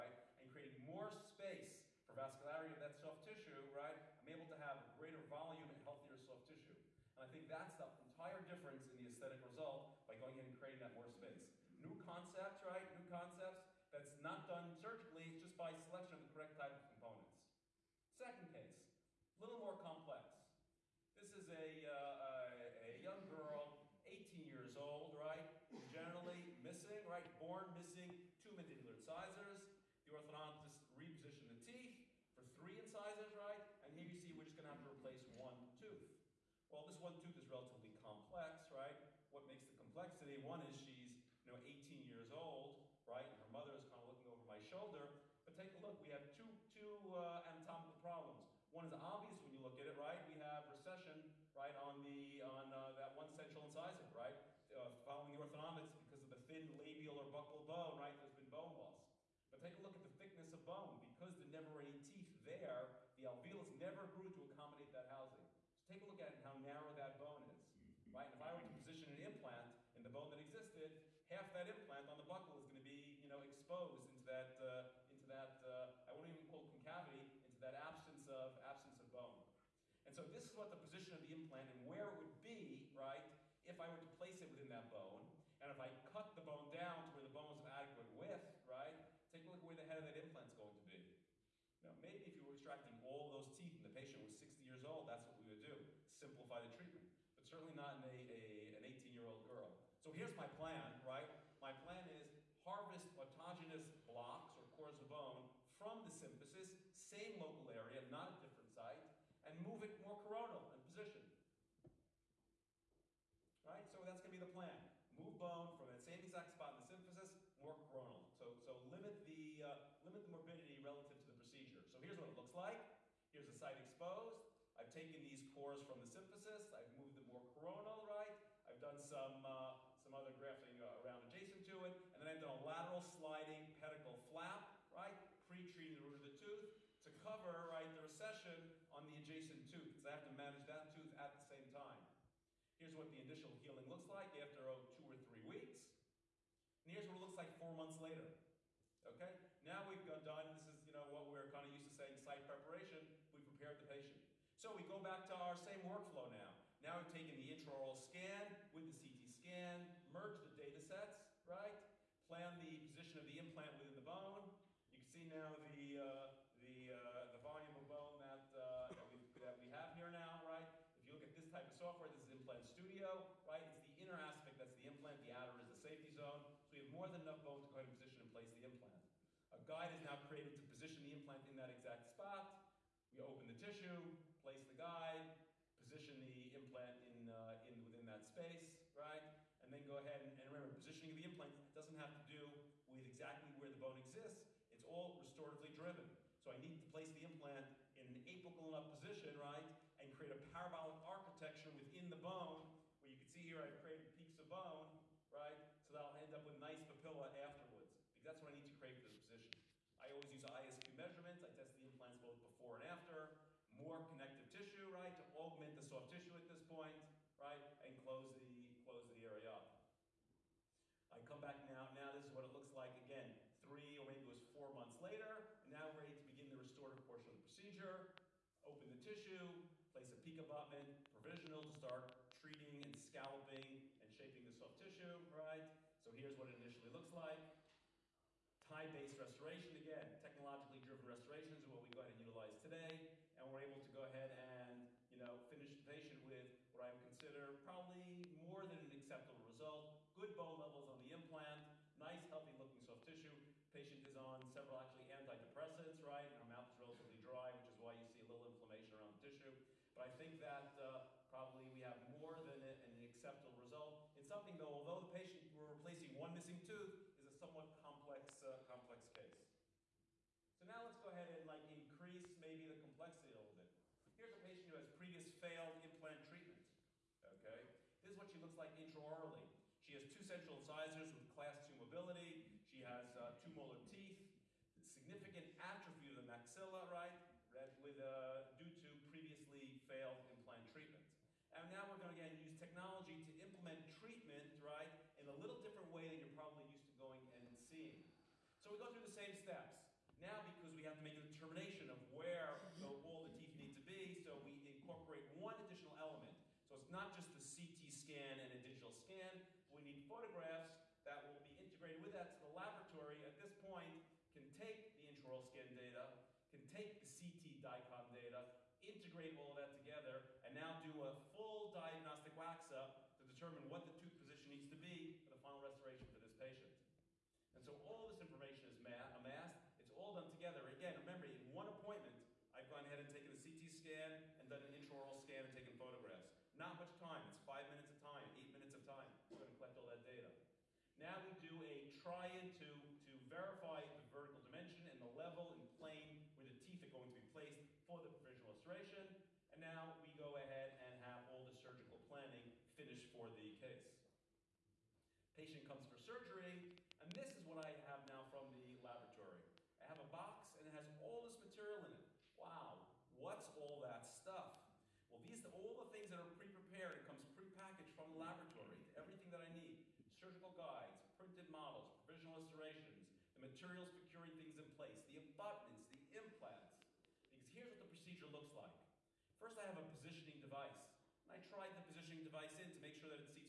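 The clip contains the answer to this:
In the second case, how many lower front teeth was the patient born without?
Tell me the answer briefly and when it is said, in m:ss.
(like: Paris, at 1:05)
2, at 0:28.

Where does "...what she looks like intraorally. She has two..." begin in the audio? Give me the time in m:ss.
4:38.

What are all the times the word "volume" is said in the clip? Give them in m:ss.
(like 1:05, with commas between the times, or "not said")
0:05, 2:47.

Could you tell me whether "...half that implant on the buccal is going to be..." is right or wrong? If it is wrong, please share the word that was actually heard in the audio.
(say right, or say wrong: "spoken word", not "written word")
right.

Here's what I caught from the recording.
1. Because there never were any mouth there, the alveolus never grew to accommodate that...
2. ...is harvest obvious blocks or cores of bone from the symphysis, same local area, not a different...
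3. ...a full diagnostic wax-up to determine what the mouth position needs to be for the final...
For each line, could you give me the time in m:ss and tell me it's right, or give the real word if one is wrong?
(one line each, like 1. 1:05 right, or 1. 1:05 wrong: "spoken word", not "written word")
1. 1:01 wrong: "teeth", not "mouth"
2. 1:42 wrong: "autogenous", not "obvious"
3. 5:21 wrong: "tooth", not "mouth".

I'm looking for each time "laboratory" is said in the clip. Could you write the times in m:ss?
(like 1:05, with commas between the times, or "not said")
5:12, 5:58, 6:08.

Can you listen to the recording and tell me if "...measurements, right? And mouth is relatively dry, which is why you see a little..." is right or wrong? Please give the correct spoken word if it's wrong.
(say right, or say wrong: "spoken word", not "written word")
wrong: "antidepressants", not "measurements".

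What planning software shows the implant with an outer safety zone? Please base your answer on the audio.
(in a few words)
Implant Studio.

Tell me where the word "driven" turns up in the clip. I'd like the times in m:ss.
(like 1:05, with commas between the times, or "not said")
3:15, 4:00.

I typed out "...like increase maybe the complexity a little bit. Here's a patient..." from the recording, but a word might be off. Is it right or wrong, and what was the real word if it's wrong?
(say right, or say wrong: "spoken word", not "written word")
right.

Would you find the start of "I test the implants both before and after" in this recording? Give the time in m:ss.
3:31.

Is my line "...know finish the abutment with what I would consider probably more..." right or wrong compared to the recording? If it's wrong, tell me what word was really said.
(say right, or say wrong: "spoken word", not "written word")
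wrong: "patient", not "abutment".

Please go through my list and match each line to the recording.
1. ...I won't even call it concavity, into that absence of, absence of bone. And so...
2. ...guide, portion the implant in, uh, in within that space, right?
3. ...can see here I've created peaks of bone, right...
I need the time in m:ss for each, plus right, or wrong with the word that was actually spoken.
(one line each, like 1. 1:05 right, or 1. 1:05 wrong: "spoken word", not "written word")
1. 1:16 right
2. 3:04 wrong: "position", not "portion"
3. 3:23 right.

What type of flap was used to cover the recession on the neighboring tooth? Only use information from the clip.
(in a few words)
Lateral sliding pedicle flap.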